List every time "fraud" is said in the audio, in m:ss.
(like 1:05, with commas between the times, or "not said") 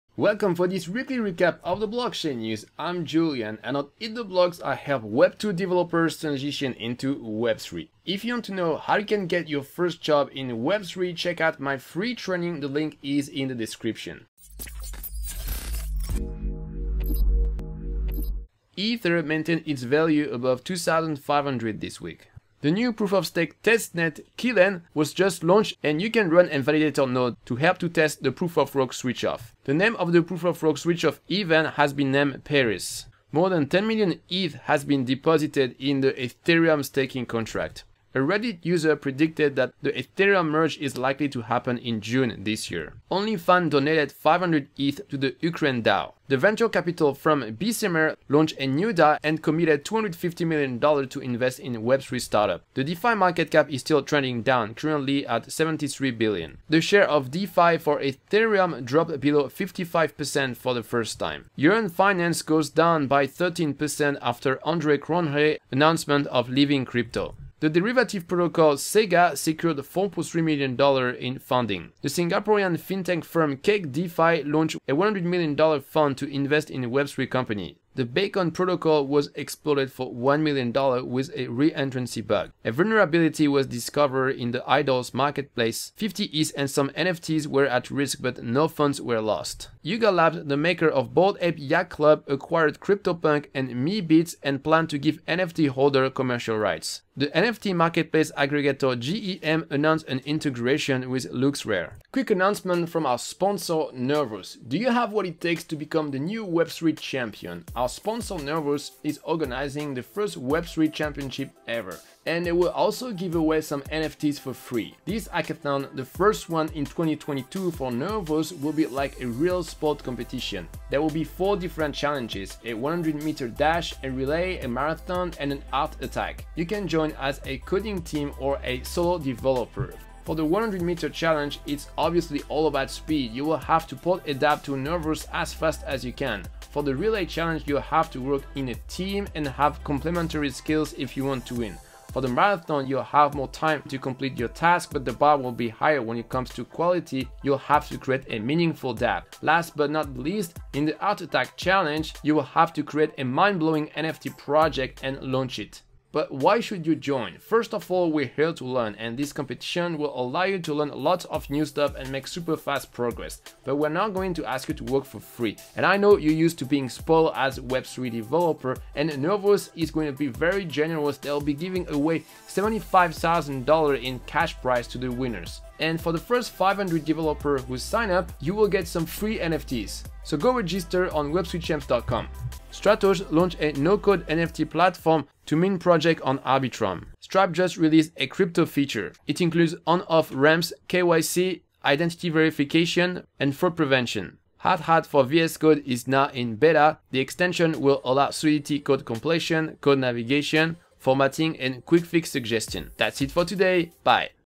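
3:13.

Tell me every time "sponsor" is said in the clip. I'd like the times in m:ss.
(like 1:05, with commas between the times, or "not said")
1:43, 1:47.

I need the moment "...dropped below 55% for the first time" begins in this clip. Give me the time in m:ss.
0:58.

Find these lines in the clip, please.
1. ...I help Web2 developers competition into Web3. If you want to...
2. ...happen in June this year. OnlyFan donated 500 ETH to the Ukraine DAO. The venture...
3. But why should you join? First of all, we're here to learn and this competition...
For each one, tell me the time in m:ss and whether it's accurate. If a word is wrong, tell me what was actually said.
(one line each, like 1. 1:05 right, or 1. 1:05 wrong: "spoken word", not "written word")
1. 0:04 wrong: "transition", not "competition"
2. 0:41 right
3. 2:36 right.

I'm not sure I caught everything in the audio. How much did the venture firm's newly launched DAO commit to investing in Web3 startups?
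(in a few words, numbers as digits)
$250 million.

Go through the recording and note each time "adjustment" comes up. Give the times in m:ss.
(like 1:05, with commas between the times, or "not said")
not said.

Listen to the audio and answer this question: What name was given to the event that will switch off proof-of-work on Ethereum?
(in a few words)
Paris.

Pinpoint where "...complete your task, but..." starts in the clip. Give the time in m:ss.
2:23.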